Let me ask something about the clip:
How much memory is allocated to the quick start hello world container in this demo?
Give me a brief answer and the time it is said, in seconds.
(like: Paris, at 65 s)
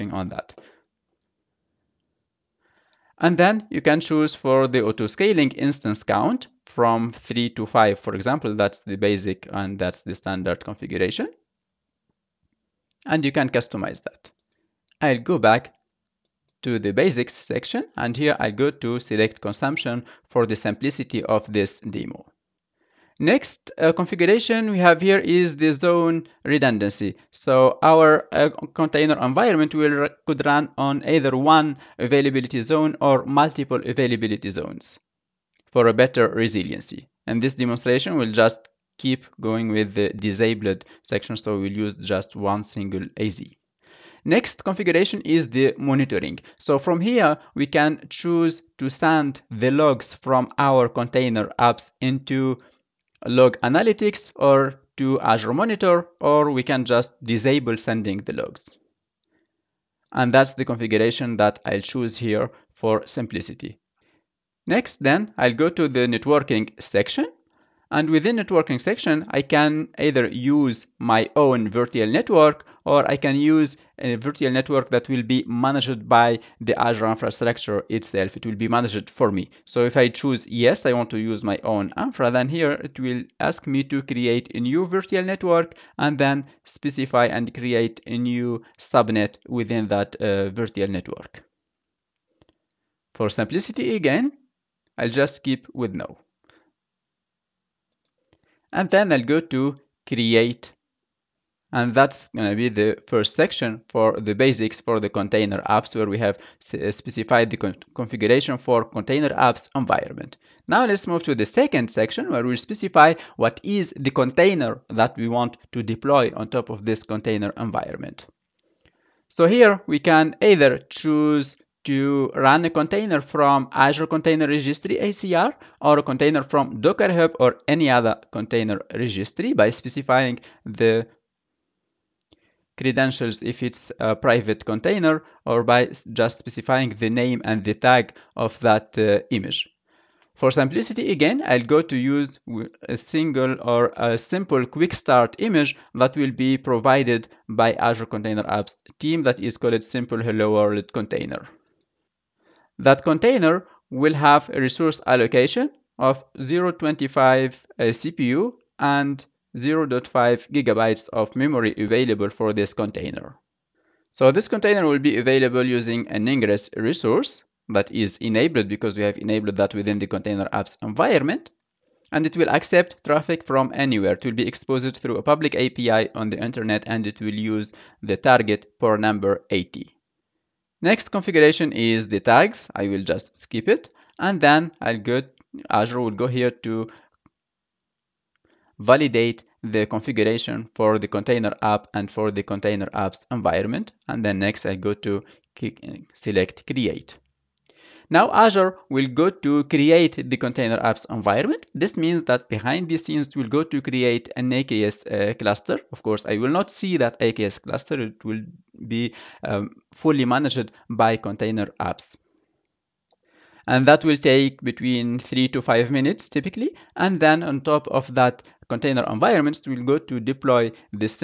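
0.5 gigabytes, at 159 s.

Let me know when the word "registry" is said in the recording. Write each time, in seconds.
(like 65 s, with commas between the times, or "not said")
124 s, 128 s.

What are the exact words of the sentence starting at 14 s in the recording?
I'll go back to the basics section and here I go to select consumption for the simplicity of this demo.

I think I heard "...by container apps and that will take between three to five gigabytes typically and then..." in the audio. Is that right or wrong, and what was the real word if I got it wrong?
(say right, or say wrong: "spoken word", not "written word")
wrong: "minutes", not "gigabytes".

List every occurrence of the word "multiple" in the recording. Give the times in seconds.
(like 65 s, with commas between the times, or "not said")
33 s.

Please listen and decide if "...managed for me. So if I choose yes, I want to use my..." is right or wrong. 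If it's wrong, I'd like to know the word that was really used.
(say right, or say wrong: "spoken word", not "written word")
right.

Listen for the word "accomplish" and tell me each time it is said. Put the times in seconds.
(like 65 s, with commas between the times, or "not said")
not said.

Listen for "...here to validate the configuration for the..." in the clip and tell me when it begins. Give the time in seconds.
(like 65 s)
186 s.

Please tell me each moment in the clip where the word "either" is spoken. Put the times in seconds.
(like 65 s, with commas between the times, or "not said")
31 s, 69 s, 120 s.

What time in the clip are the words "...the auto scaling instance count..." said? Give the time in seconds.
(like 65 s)
4 s.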